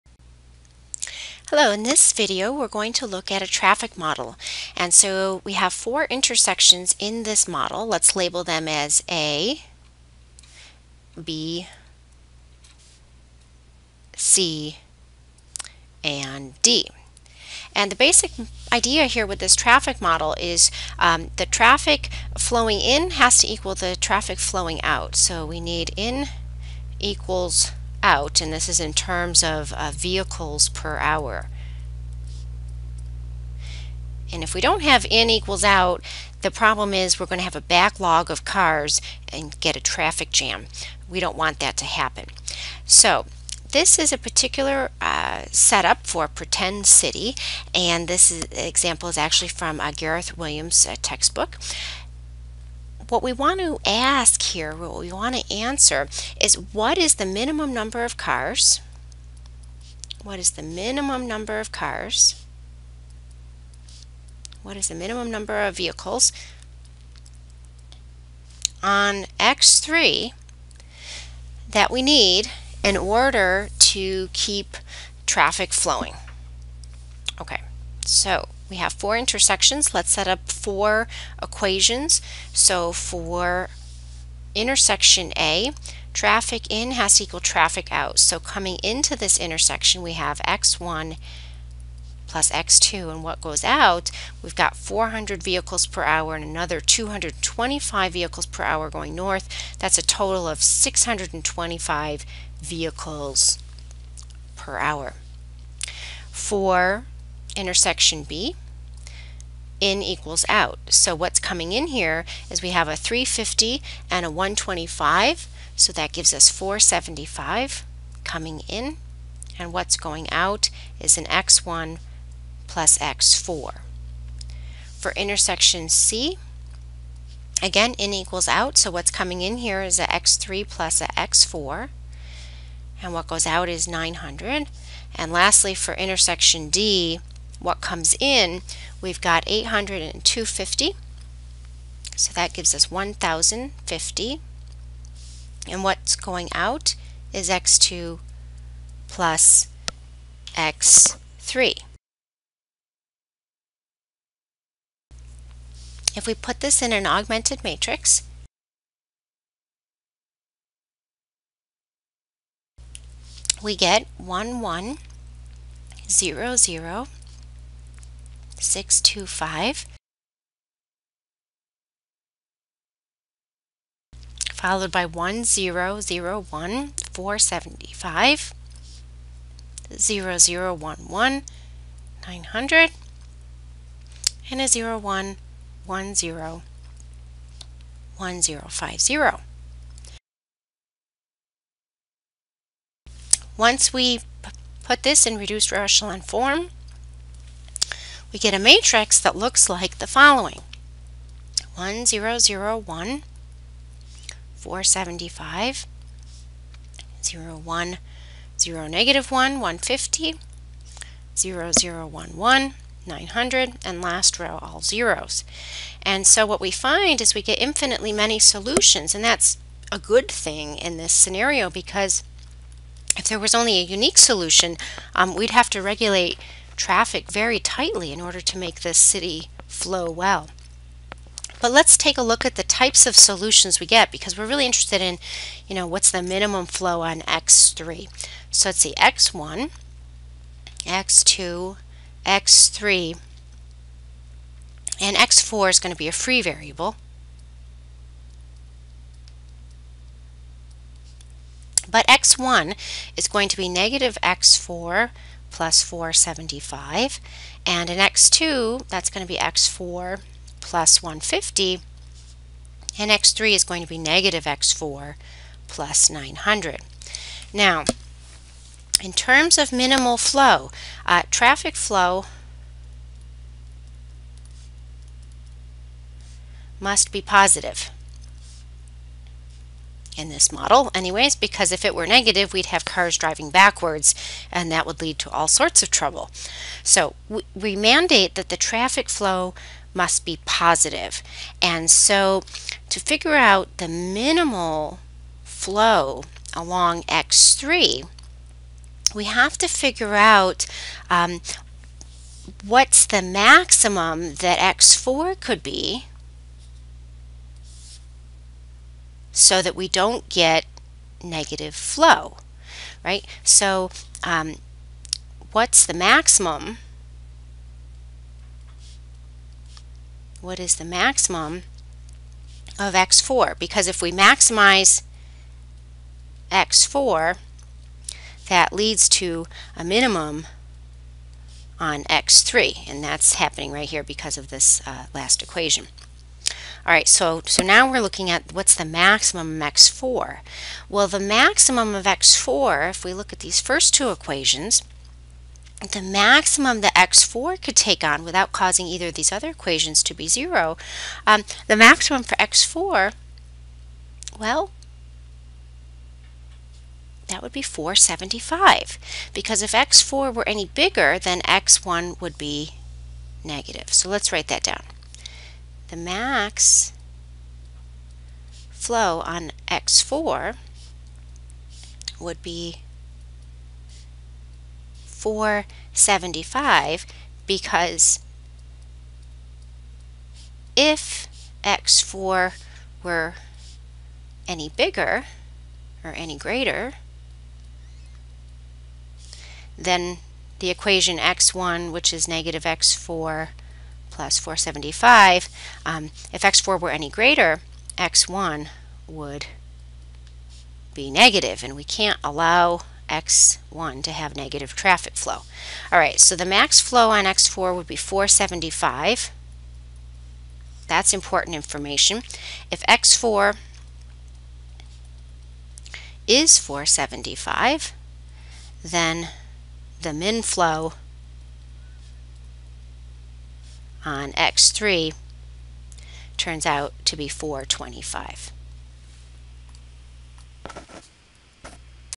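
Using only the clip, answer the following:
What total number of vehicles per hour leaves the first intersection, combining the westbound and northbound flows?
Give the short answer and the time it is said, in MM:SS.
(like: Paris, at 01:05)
625, at 01:40.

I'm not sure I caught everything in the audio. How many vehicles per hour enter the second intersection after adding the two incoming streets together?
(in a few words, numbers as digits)
475.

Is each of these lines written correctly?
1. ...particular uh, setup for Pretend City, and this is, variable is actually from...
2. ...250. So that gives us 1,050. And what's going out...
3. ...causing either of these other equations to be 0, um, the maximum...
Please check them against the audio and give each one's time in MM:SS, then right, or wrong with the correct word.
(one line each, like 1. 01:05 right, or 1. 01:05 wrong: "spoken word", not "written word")
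1. 00:44 wrong: "example", not "variable"
2. 02:20 right
3. 05:48 right.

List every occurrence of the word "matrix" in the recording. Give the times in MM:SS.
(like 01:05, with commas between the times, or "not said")
02:37, 03:18.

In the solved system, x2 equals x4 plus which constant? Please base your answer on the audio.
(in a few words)
150.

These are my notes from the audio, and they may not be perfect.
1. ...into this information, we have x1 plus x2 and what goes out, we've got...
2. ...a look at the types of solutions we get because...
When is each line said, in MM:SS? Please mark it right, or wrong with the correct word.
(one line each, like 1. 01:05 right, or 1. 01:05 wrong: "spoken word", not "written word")
1. 01:28 wrong: "intersection", not "information"
2. 03:52 right.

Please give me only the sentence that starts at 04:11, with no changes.
But x1 is going to be negative x4 plus 475.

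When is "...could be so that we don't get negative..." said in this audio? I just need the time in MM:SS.
05:05.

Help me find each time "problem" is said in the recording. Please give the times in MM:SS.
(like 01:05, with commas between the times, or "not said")
00:36.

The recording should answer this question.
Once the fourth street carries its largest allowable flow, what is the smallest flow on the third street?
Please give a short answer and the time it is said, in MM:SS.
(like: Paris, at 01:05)
425, at 07:07.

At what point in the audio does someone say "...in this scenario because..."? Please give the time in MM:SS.
03:40.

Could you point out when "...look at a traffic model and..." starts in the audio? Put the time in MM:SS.
00:03.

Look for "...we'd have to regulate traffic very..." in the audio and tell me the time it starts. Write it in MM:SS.
03:45.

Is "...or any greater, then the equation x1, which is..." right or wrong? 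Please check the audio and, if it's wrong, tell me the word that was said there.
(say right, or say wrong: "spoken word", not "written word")
right.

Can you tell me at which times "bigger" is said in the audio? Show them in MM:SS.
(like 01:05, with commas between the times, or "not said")
06:00, 06:24.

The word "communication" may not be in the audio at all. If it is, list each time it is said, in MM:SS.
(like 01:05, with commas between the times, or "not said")
not said.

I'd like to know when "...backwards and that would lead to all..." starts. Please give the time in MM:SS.
04:43.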